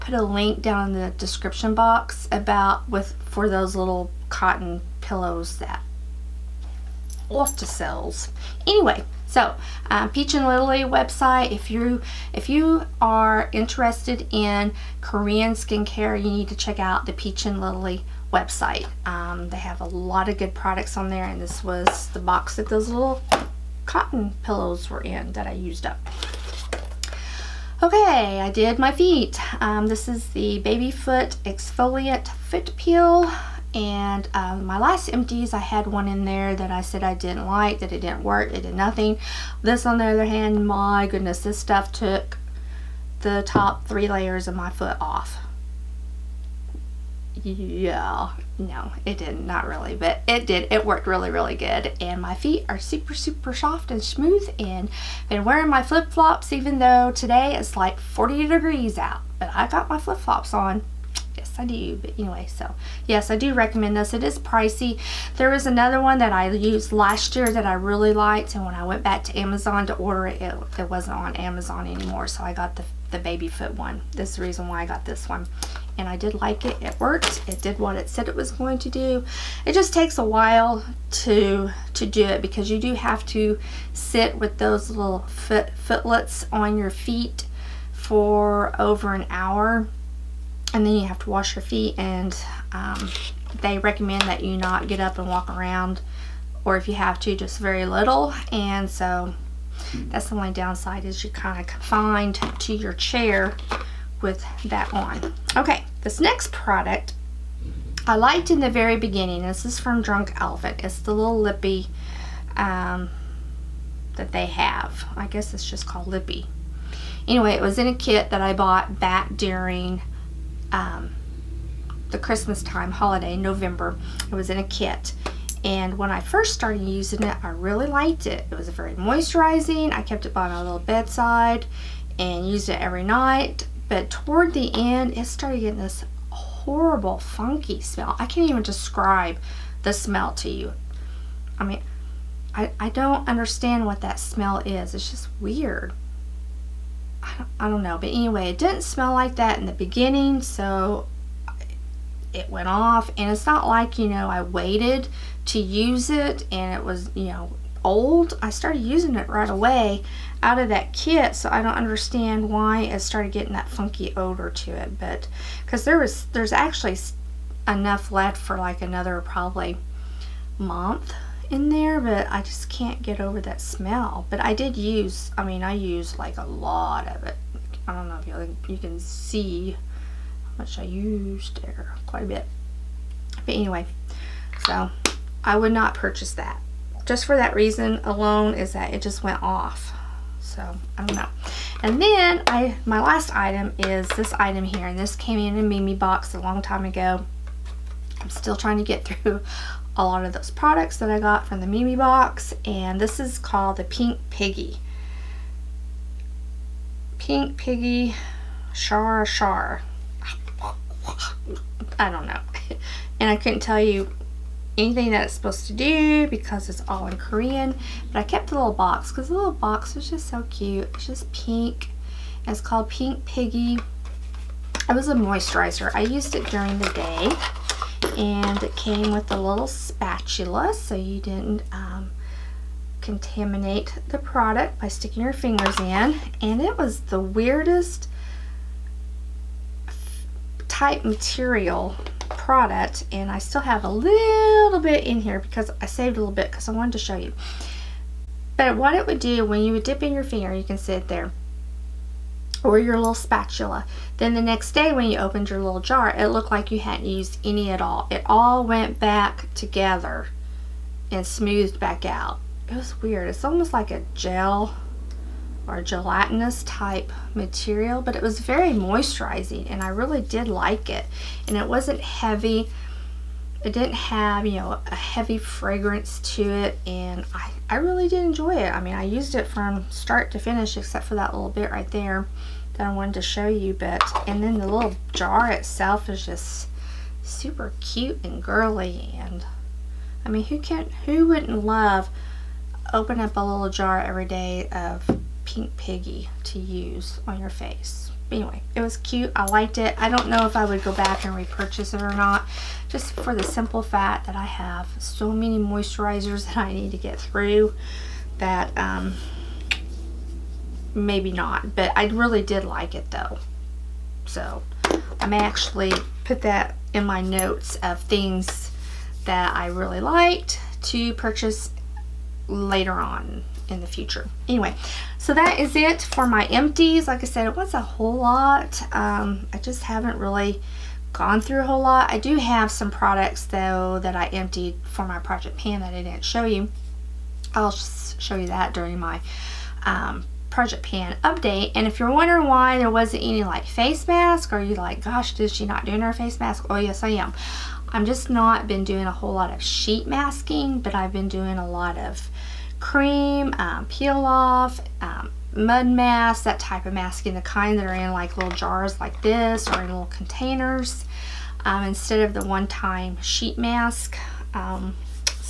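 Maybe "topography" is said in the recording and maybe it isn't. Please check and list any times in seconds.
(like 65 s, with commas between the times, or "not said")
not said.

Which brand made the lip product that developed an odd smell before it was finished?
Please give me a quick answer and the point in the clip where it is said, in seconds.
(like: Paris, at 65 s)
Drunk Elephant, at 110 s.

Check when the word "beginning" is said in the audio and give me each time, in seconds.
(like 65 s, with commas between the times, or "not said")
108 s, 149 s.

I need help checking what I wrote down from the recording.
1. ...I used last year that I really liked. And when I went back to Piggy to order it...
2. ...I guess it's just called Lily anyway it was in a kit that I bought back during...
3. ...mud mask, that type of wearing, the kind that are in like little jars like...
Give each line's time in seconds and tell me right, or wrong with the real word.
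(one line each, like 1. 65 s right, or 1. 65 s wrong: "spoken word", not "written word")
1. 66 s wrong: "Amazon", not "Piggy"
2. 115 s wrong: "Lippe", not "Lily"
3. 355 s wrong: "masking", not "wearing".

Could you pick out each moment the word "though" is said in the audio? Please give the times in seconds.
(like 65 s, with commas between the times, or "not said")
56 s, 313 s, 333 s.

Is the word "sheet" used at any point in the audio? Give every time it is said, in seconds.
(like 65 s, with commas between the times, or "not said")
349 s, 363 s.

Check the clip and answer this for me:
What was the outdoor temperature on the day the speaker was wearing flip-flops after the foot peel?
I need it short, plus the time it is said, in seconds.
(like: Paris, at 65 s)
40 degrees, at 57 s.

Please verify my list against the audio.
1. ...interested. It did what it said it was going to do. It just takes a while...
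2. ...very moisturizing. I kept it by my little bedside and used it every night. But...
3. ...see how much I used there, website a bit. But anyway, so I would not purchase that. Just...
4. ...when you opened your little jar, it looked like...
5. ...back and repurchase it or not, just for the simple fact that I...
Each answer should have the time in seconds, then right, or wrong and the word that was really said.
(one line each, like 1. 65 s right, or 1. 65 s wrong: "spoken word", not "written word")
1. 76 s wrong: "worked", not "interested"
2. 128 s right
3. 178 s wrong: "quite", not "website"
4. 254 s right
5. 300 s right.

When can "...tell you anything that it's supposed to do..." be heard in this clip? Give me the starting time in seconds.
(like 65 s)
213 s.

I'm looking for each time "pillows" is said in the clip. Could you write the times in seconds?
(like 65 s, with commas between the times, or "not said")
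4 s, 24 s.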